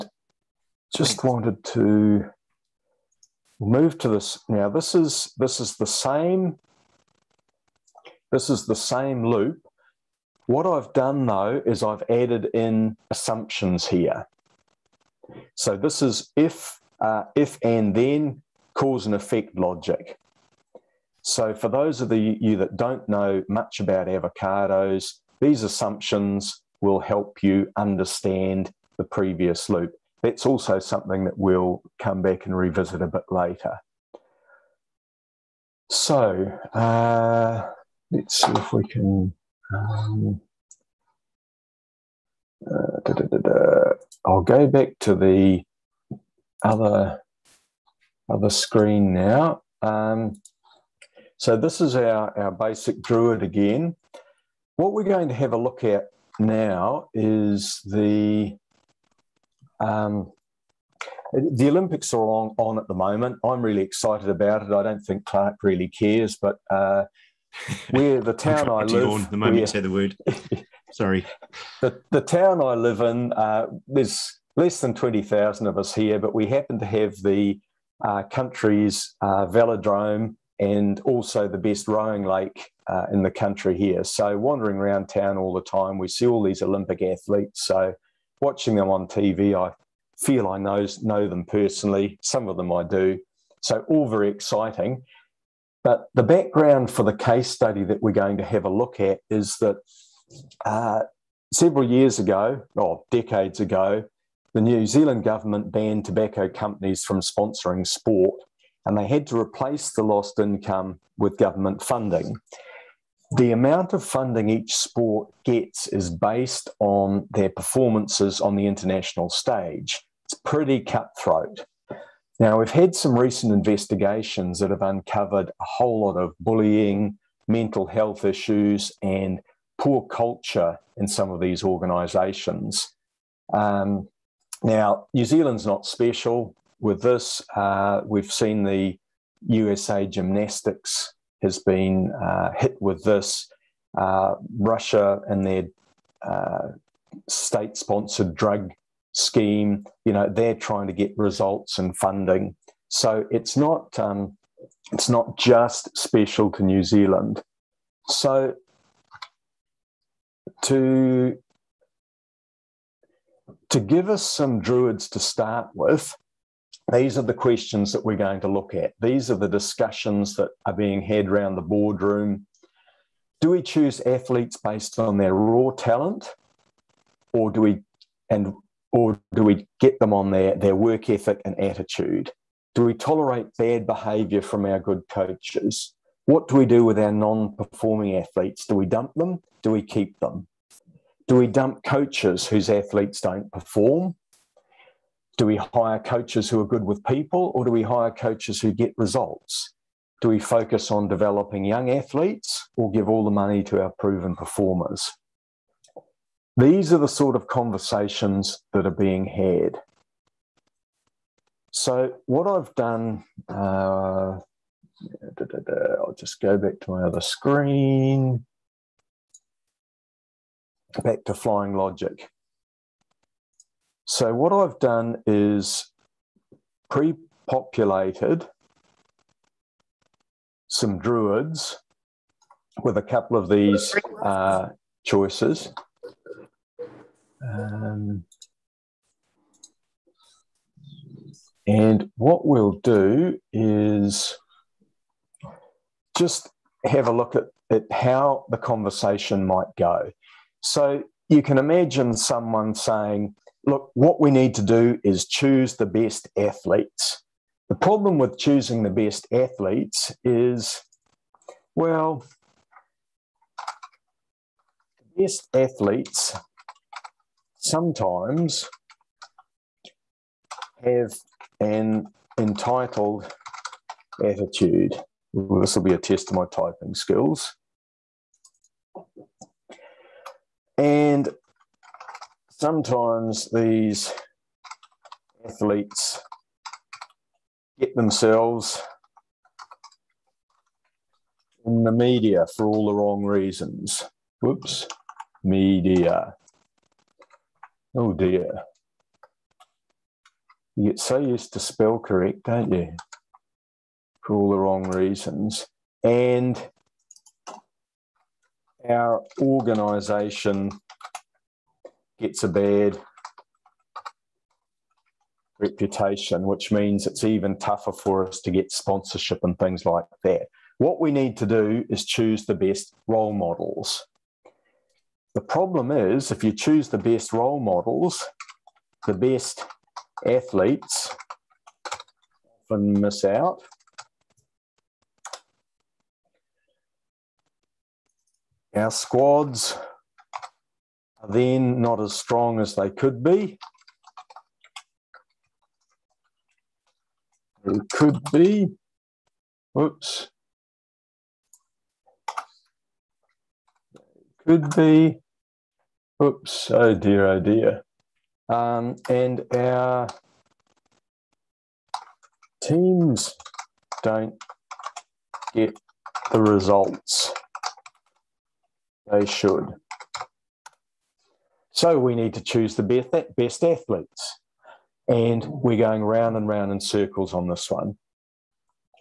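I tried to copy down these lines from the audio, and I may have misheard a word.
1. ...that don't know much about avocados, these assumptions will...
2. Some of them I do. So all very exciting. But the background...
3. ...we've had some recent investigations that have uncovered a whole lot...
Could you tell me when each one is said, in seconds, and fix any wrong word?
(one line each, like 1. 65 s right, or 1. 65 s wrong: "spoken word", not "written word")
1. 22 s right
2. 92 s right
3. 122 s right.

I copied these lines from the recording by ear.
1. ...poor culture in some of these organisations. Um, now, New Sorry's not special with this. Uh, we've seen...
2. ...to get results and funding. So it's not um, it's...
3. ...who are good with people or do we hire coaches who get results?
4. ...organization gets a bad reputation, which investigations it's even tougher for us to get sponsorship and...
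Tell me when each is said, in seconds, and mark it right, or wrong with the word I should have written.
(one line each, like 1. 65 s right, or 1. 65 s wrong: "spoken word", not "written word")
1. 129 s wrong: "Zealand", not "Sorry"
2. 150 s right
3. 196 s right
4. 309 s wrong: "means", not "investigations".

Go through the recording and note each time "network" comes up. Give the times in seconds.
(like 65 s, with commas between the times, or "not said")
not said.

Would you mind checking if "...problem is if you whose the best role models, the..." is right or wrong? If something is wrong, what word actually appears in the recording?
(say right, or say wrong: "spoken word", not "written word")
wrong: "choose", not "whose".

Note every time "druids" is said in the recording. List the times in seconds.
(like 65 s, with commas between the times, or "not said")
53 s, 164 s, 230 s.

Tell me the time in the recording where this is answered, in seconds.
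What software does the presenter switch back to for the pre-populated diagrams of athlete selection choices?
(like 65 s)
221 s.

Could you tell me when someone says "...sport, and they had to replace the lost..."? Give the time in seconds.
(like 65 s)
107 s.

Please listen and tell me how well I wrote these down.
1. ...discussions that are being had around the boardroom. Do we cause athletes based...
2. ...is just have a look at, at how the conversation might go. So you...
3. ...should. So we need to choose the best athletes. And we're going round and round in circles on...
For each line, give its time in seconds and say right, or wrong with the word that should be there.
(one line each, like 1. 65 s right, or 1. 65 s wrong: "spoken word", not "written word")
1. 169 s wrong: "choose", not "cause"
2. 243 s right
3. 369 s right.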